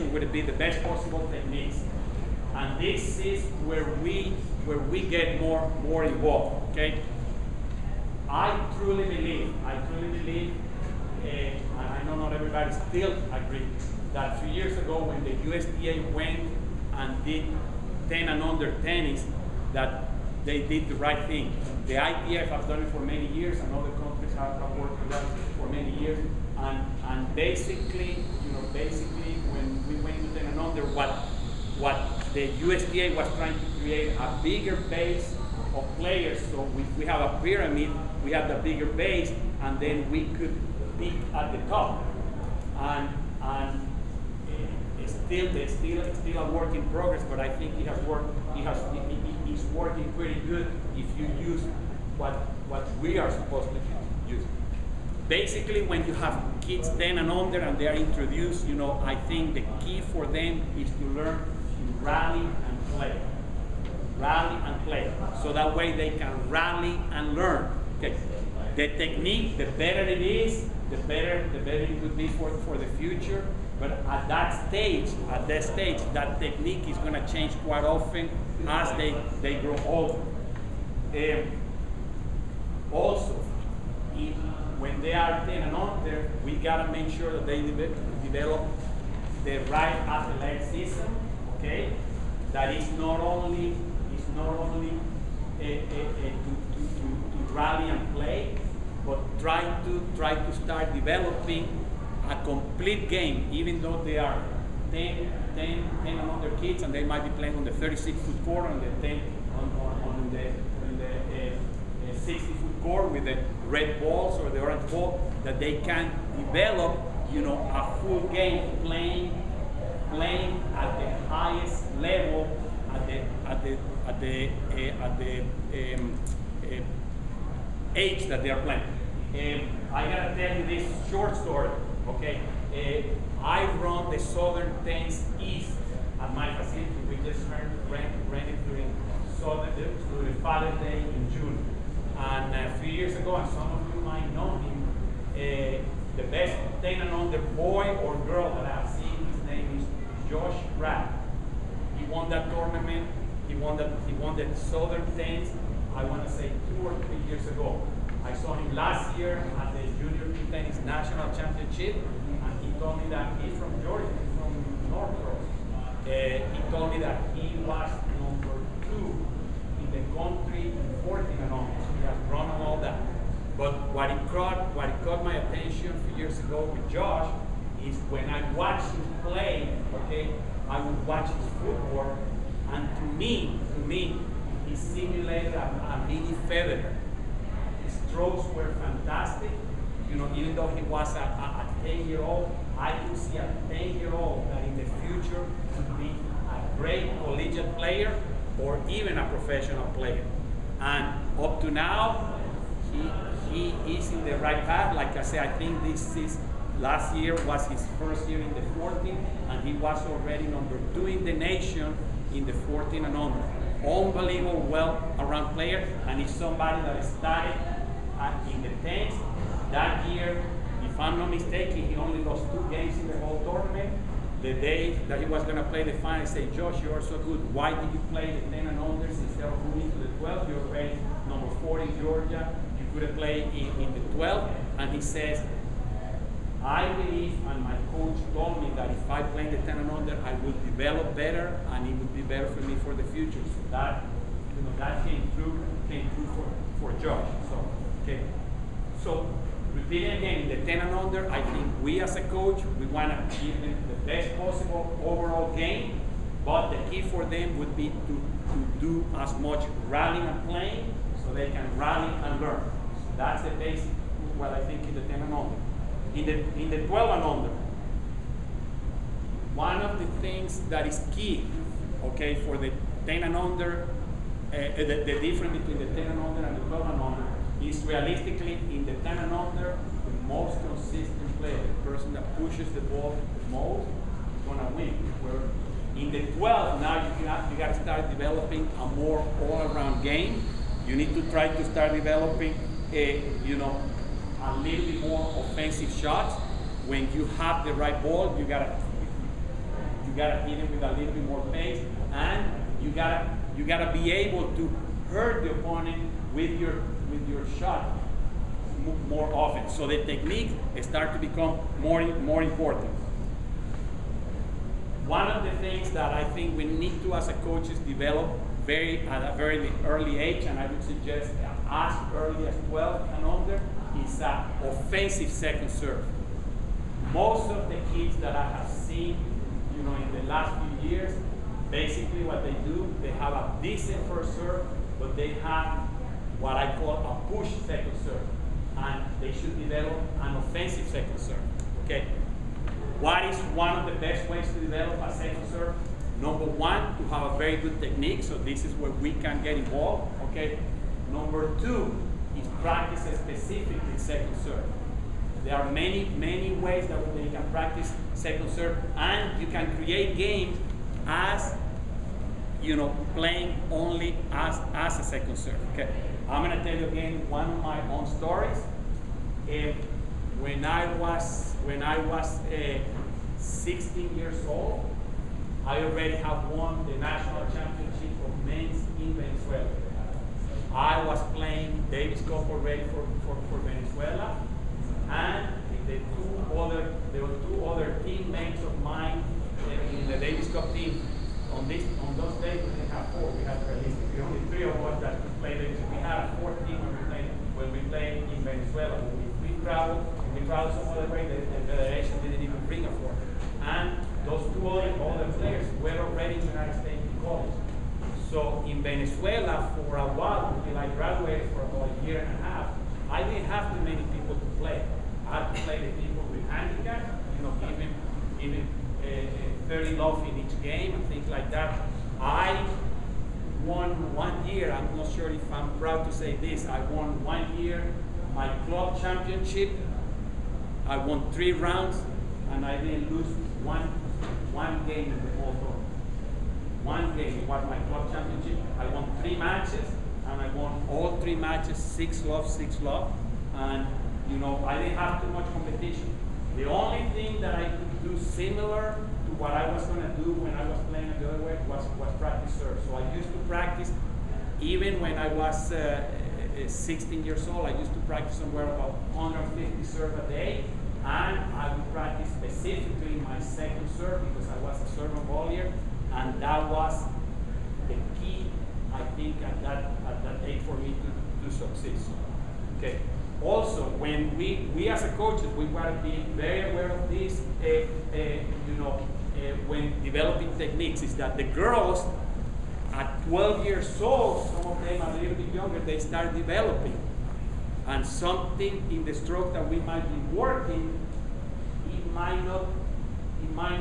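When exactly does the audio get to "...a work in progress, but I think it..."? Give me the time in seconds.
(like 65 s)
46 s.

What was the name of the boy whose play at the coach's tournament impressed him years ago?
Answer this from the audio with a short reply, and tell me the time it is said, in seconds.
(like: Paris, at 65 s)
Josh Rapp, at 150 s.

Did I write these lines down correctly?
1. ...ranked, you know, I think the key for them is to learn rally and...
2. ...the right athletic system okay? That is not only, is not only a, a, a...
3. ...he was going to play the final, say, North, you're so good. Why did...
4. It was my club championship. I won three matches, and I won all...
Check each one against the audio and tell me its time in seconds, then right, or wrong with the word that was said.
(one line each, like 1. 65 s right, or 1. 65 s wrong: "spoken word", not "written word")
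1. 57 s wrong: "introduced", not "ranked"
2. 89 s right
3. 225 s wrong: "Josh", not "North"
4. 437 s right.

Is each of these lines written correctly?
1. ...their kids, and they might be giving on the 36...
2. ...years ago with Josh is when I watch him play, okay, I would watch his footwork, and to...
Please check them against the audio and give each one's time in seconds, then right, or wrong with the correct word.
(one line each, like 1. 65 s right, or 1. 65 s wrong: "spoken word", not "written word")
1. 106 s wrong: "playing", not "giving"
2. 176 s right.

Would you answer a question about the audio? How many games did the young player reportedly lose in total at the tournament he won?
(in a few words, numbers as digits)
2.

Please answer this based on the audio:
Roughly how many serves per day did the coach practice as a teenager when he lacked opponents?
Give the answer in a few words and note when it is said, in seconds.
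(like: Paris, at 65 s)
150, at 459 s.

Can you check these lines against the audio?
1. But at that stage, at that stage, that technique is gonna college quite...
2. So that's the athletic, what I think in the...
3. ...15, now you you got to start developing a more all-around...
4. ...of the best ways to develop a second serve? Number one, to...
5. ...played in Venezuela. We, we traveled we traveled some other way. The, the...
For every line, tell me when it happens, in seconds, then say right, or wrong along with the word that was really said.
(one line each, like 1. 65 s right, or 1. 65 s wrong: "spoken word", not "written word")
1. 73 s wrong: "change", not "college"
2. 262 s wrong: "basic", not "athletic"
3. 286 s wrong: "12", not "15"
4. 343 s right
5. 397 s right.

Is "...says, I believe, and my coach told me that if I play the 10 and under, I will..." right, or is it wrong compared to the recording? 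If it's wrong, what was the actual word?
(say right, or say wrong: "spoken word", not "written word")
right.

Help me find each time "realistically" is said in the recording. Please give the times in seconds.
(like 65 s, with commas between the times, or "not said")
277 s, 393 s.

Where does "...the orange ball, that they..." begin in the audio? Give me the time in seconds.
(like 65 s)
114 s.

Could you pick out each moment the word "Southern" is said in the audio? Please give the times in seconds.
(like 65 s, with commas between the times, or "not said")
134 s, 139 s, 154 s.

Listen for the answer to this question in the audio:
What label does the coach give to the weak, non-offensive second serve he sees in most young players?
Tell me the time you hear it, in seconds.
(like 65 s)
337 s.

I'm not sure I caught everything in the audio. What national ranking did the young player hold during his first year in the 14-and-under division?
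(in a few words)
Number 2.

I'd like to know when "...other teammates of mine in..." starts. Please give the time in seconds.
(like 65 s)
387 s.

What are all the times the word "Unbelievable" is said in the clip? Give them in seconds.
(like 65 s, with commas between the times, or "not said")
213 s.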